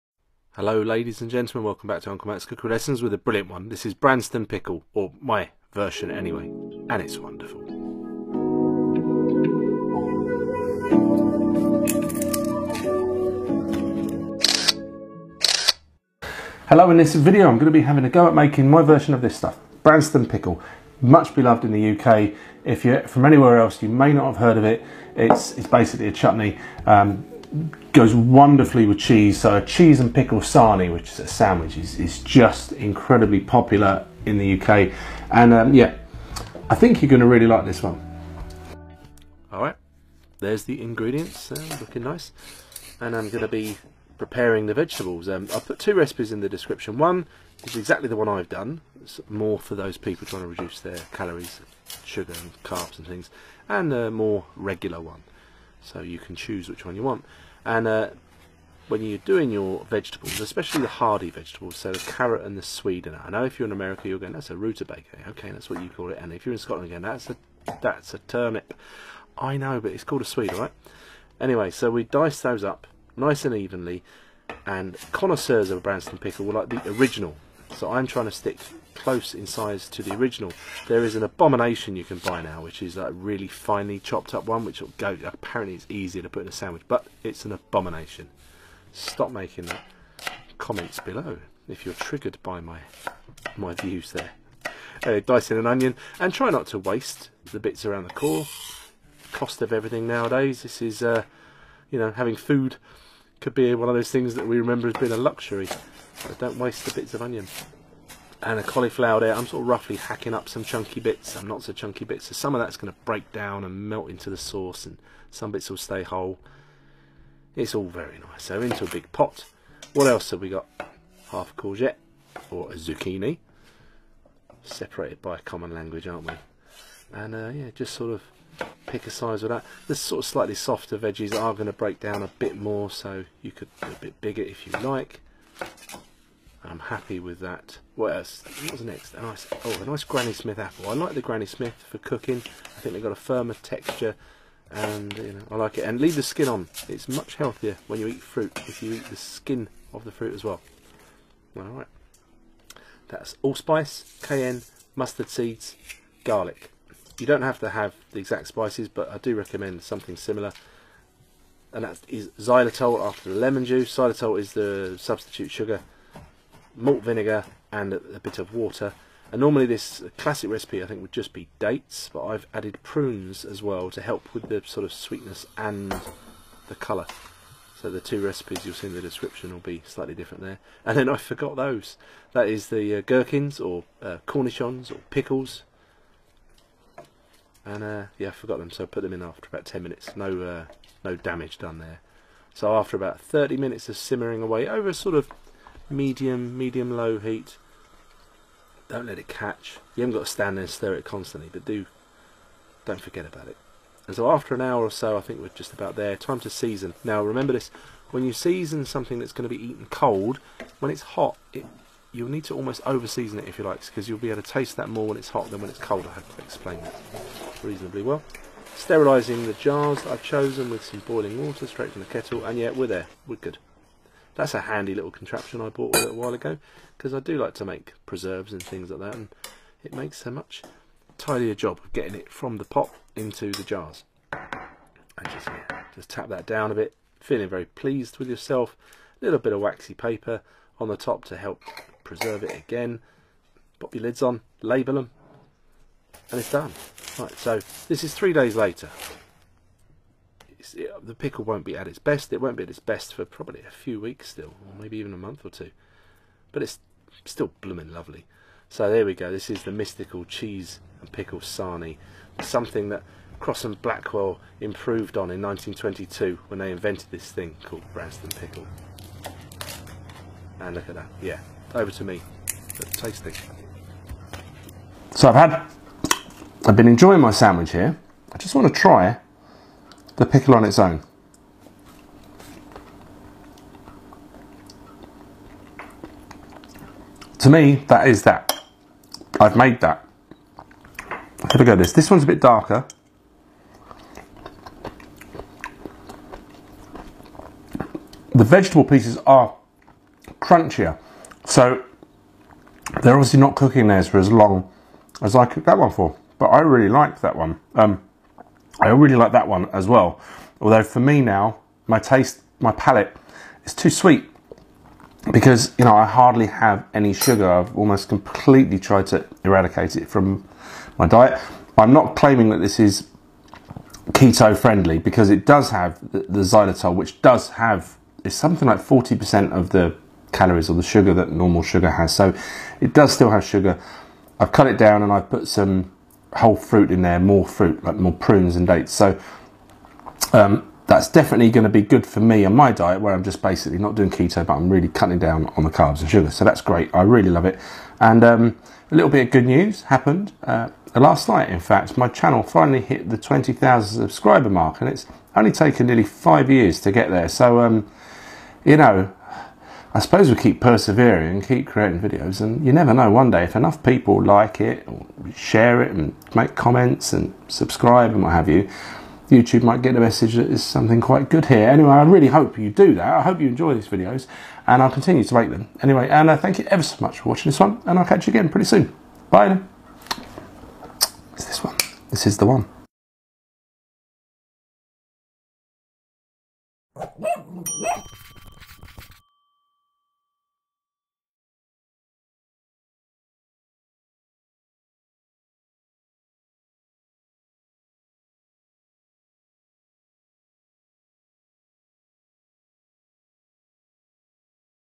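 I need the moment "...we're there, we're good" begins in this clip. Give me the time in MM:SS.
03:42.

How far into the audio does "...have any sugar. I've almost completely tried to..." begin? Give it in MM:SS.
05:16.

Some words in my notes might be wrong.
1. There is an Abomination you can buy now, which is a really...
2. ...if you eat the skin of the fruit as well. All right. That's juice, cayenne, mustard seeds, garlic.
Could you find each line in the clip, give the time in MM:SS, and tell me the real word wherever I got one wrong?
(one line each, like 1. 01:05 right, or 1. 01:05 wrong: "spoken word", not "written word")
1. 01:20 right
2. 02:28 wrong: "allspice", not "juice".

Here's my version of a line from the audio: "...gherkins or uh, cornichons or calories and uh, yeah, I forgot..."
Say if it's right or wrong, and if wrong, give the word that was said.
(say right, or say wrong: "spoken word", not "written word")
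wrong: "pickles", not "calories".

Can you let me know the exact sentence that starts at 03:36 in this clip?
I have to explain that reasonably well.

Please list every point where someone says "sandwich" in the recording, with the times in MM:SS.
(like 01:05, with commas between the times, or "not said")
00:31, 01:26, 04:37.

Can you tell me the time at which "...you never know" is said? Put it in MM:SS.
06:02.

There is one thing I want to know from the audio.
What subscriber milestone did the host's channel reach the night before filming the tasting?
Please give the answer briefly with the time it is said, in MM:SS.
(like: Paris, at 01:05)
20,000, at 05:53.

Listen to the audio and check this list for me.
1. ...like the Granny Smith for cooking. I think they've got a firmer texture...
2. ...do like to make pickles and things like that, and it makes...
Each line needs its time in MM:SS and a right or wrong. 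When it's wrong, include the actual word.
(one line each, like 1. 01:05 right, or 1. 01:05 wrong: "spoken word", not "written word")
1. 02:20 right
2. 03:47 wrong: "preserves", not "pickles".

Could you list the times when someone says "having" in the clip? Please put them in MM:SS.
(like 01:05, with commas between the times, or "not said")
00:17, 01:42.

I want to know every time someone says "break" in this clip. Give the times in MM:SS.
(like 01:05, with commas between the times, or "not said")
01:53, 02:11.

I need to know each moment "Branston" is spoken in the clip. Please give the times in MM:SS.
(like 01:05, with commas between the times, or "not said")
00:03, 00:19, 01:15, 04:27.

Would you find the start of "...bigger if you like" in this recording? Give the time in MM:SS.
02:14.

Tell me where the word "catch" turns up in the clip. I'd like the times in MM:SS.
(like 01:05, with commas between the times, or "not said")
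03:19, 06:18.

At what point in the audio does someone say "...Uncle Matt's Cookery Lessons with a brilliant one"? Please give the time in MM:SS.
00:02.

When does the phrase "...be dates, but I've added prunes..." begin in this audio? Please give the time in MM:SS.
02:51.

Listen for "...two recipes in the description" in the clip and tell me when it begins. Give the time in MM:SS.
00:45.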